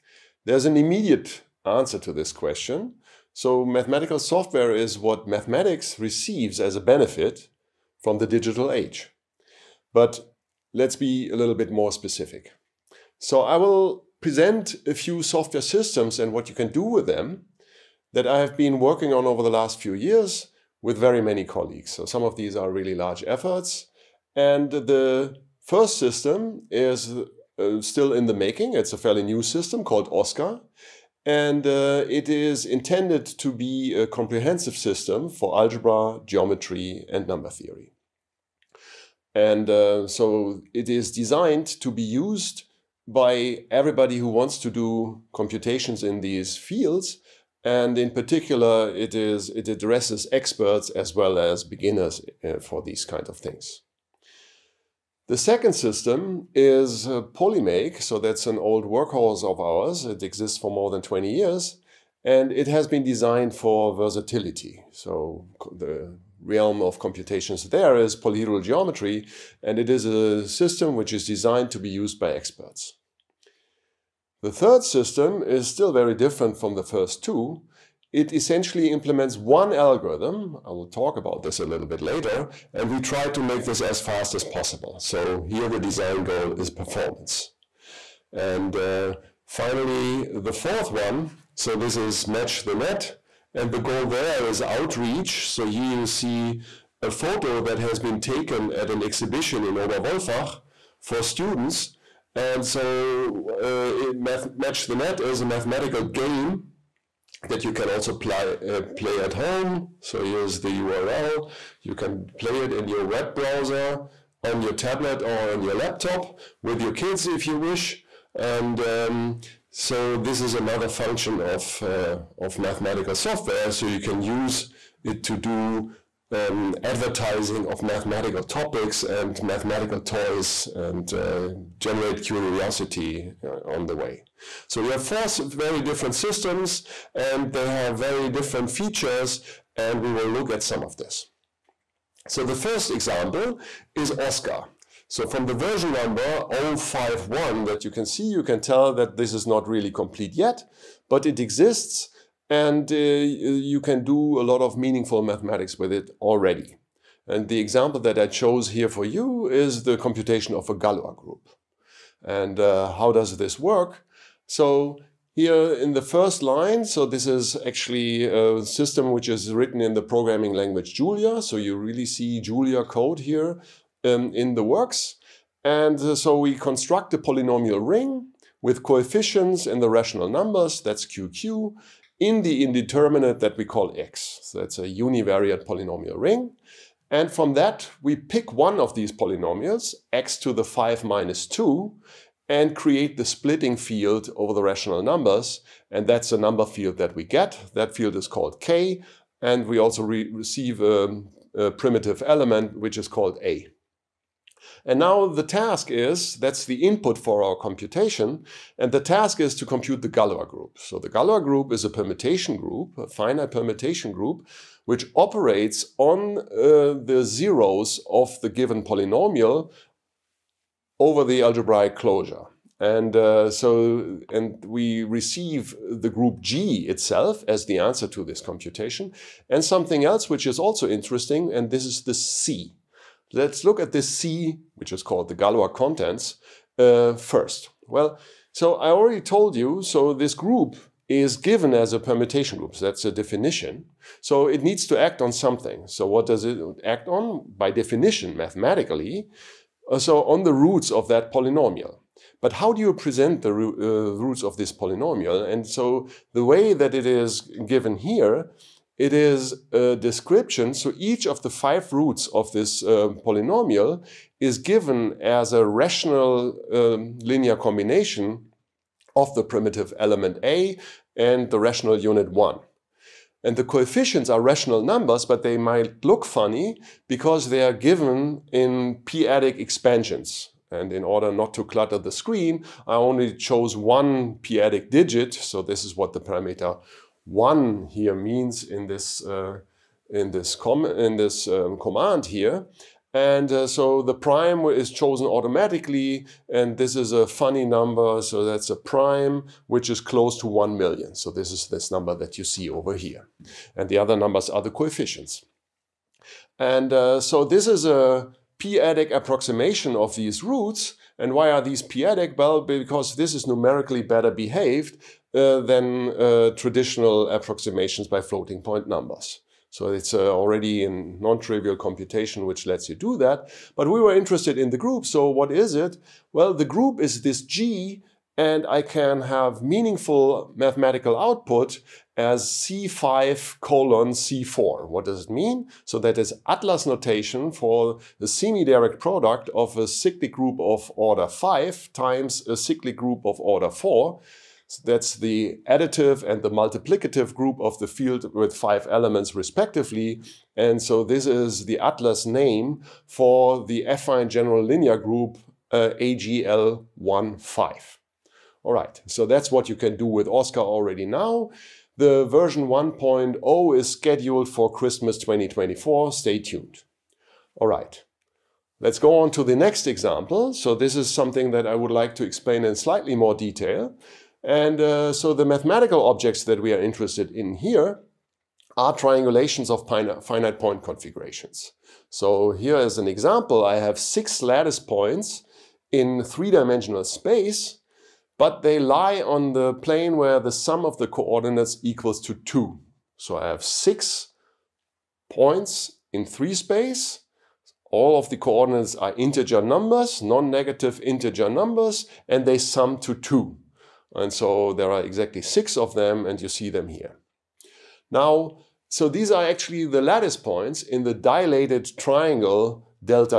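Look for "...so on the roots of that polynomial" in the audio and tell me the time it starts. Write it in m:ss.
4:09.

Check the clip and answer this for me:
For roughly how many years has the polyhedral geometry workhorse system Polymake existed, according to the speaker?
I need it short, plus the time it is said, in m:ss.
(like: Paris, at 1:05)
more than 20, at 1:00.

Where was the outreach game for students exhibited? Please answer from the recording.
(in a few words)
Oberwolfach.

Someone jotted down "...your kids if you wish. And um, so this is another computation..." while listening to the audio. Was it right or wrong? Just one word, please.
wrong.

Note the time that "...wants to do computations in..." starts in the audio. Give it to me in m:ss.
0:44.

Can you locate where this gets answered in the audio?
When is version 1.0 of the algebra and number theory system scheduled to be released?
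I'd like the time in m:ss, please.
6:04.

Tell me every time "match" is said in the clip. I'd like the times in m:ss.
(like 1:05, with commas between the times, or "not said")
1:32, 1:44.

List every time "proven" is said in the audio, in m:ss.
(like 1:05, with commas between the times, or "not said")
not said.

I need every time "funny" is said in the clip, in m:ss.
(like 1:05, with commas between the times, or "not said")
4:36, 4:57.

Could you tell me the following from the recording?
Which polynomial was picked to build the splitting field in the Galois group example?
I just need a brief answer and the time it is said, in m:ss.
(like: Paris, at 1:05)
x^5 - 2, at 3:10.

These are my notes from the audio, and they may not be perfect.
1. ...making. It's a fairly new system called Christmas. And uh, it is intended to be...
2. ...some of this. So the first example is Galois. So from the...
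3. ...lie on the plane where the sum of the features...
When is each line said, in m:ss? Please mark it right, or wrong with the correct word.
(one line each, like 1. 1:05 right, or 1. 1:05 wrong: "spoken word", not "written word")
1. 0:28 wrong: "OSCAR", not "Christmas"
2. 2:20 wrong: "Oscar", not "Galois"
3. 6:28 wrong: "coordinates", not "features".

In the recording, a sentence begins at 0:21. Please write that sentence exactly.
So some of these are really large efforts.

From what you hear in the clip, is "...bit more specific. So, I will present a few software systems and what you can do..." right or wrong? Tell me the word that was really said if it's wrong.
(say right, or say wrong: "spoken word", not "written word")
right.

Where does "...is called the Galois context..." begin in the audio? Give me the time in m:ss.
3:54.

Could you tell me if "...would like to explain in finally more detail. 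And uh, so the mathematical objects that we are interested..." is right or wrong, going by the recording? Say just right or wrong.
wrong.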